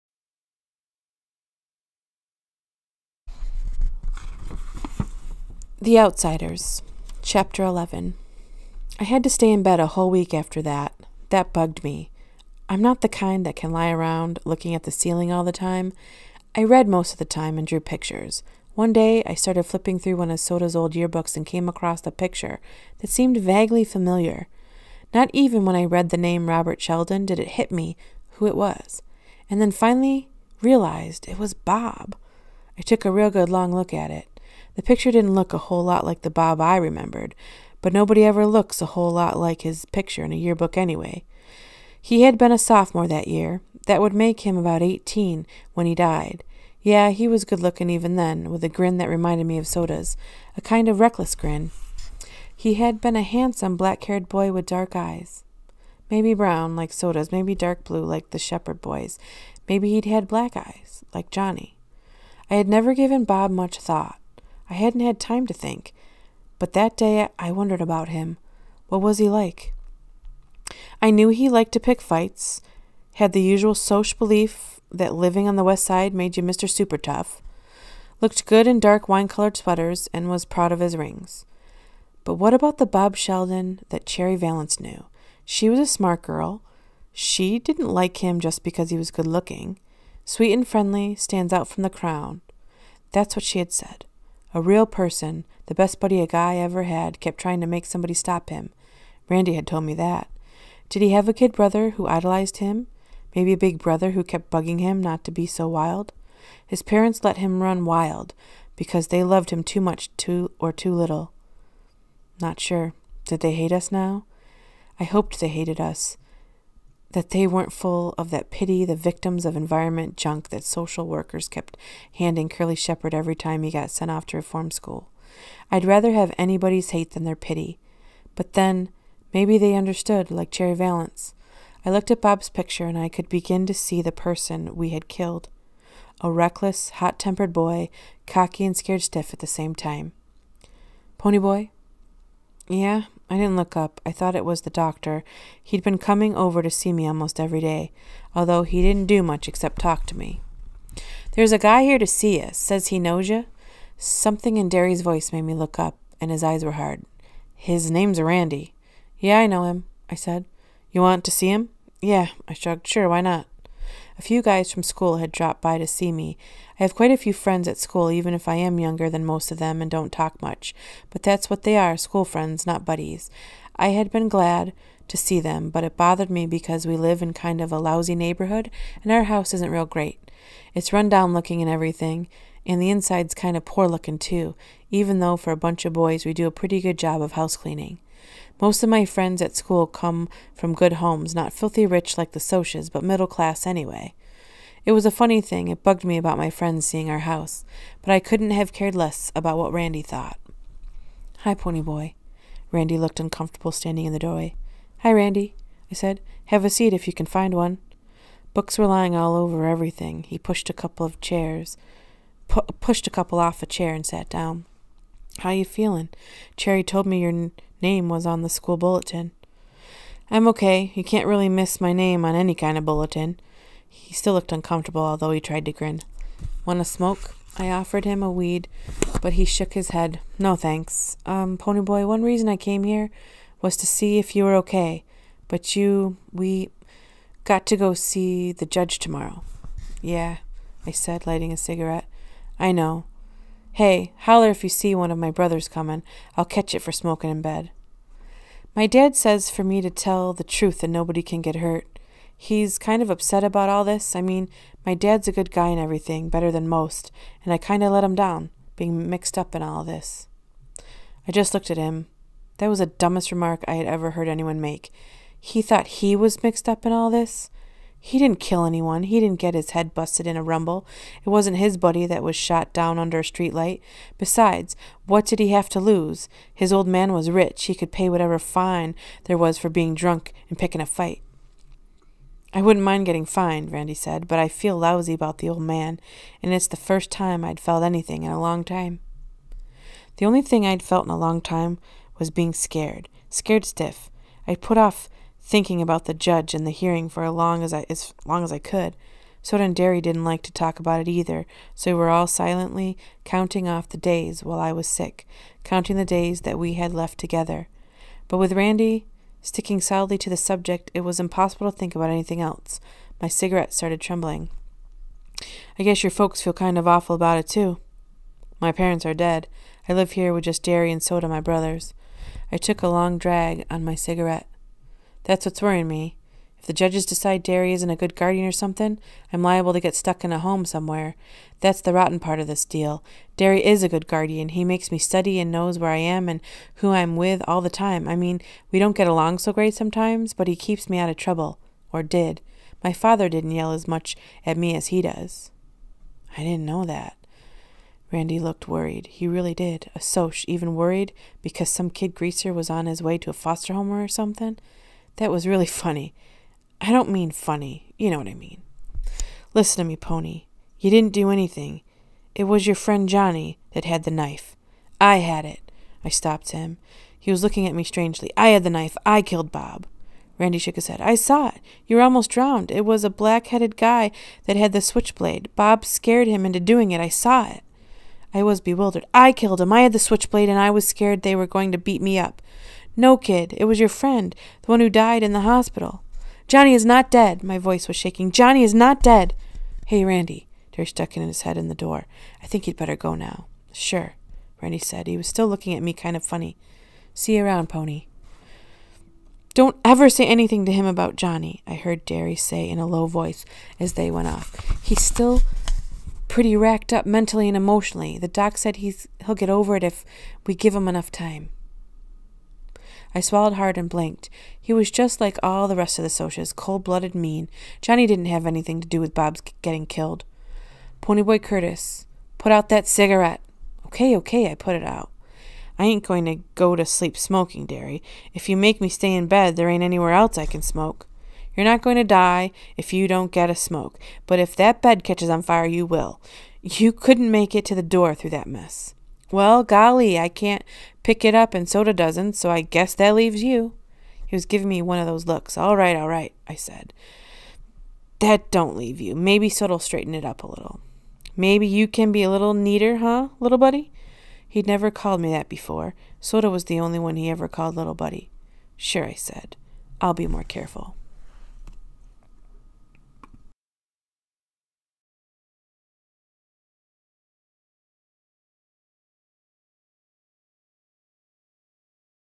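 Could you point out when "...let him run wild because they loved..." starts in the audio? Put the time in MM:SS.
01:47.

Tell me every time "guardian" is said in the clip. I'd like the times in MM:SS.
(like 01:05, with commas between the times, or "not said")
05:28, 05:34.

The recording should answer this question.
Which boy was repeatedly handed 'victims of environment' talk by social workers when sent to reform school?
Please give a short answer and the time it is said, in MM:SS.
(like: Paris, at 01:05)
Curly Shepard, at 02:02.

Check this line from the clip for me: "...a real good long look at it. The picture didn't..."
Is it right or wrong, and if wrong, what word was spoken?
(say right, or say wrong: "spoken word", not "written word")
right.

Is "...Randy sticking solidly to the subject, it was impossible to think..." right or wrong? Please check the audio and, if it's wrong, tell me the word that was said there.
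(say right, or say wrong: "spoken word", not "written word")
right.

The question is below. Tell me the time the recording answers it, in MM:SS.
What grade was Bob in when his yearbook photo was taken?
00:42.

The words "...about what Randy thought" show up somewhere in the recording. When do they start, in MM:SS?
03:19.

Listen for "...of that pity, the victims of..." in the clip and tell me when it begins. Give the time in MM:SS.
01:58.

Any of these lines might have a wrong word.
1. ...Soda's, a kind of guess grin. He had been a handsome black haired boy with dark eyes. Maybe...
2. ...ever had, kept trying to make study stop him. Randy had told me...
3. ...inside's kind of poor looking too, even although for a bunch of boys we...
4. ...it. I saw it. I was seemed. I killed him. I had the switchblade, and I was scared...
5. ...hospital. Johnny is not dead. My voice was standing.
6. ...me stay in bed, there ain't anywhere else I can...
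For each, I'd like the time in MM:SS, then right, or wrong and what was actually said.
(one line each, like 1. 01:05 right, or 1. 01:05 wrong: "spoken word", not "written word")
1. 00:49 wrong: "reckless", not "guess"
2. 01:36 wrong: "somebody", not "study"
3. 03:02 wrong: "though", not "although"
4. 06:16 wrong: "bewildered", not "seemed"
5. 06:25 wrong: "shaking", not "standing"
6. 07:08 right.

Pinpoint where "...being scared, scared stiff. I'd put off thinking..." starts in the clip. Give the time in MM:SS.
04:52.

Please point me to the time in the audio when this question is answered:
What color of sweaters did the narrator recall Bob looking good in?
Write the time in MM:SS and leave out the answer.
01:18.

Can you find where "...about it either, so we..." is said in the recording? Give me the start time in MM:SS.
05:00.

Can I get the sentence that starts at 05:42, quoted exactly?
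My father didn't yell as much at me as he does.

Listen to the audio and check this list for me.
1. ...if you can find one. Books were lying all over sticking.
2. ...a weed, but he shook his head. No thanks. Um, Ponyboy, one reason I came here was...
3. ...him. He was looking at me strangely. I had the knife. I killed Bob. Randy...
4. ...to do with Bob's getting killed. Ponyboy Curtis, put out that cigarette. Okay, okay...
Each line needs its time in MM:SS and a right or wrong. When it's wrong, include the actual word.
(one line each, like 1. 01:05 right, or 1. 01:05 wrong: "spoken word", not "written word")
1. 03:26 wrong: "everything", not "sticking"
2. 03:48 right
3. 06:06 right
4. 06:58 right.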